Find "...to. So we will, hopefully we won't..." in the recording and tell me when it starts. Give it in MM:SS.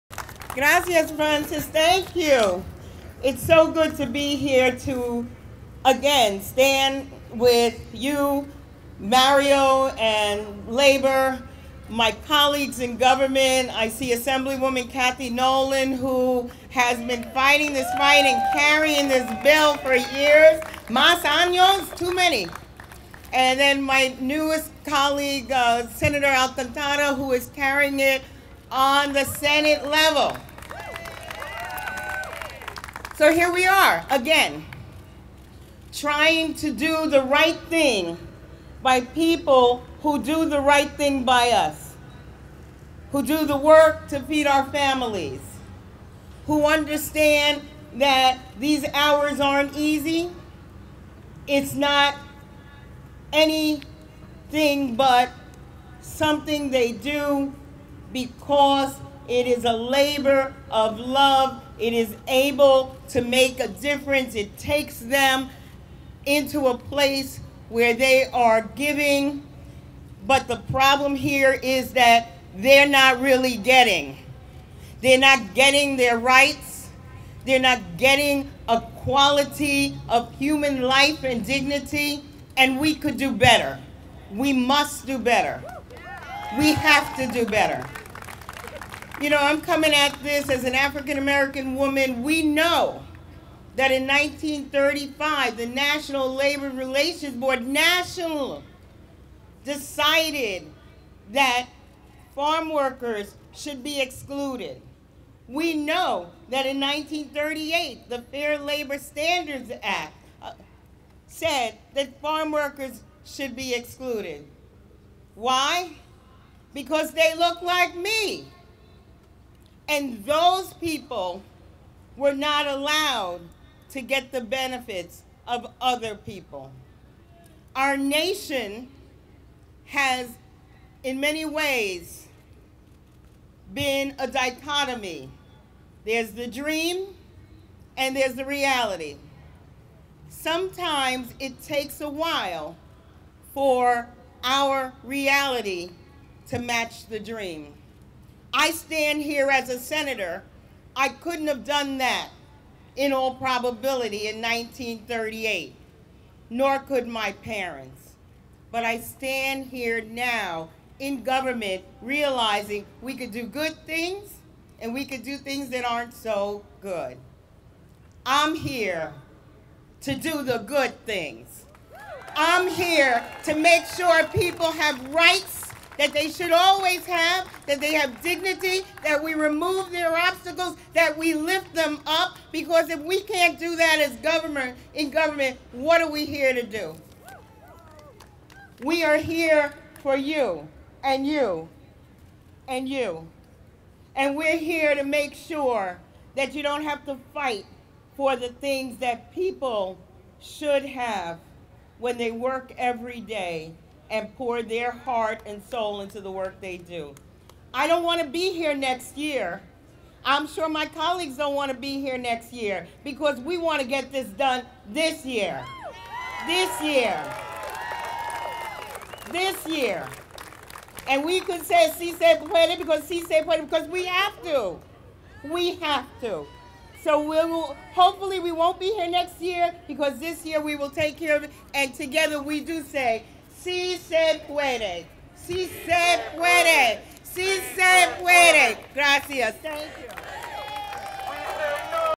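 03:46.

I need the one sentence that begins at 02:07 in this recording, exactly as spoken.
Our nation has, in many ways, been a dichotomy.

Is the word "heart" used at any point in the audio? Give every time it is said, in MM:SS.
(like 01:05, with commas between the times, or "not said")
03:24.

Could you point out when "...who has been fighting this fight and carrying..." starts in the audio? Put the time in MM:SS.
00:15.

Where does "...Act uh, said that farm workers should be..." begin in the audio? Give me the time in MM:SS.
01:49.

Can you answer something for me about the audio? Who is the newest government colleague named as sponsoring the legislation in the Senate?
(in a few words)
Senator Alcantara.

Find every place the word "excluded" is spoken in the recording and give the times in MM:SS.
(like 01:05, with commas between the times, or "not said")
01:44, 01:53.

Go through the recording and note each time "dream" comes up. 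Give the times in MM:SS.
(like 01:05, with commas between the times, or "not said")
02:16, 02:27.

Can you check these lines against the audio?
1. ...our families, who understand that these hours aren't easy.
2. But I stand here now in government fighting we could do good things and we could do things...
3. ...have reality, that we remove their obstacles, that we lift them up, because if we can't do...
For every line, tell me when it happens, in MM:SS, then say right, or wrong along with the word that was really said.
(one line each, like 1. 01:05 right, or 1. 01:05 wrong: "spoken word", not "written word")
1. 00:44 right
2. 02:38 wrong: "realizing", not "fighting"
3. 02:57 wrong: "dignity", not "reality".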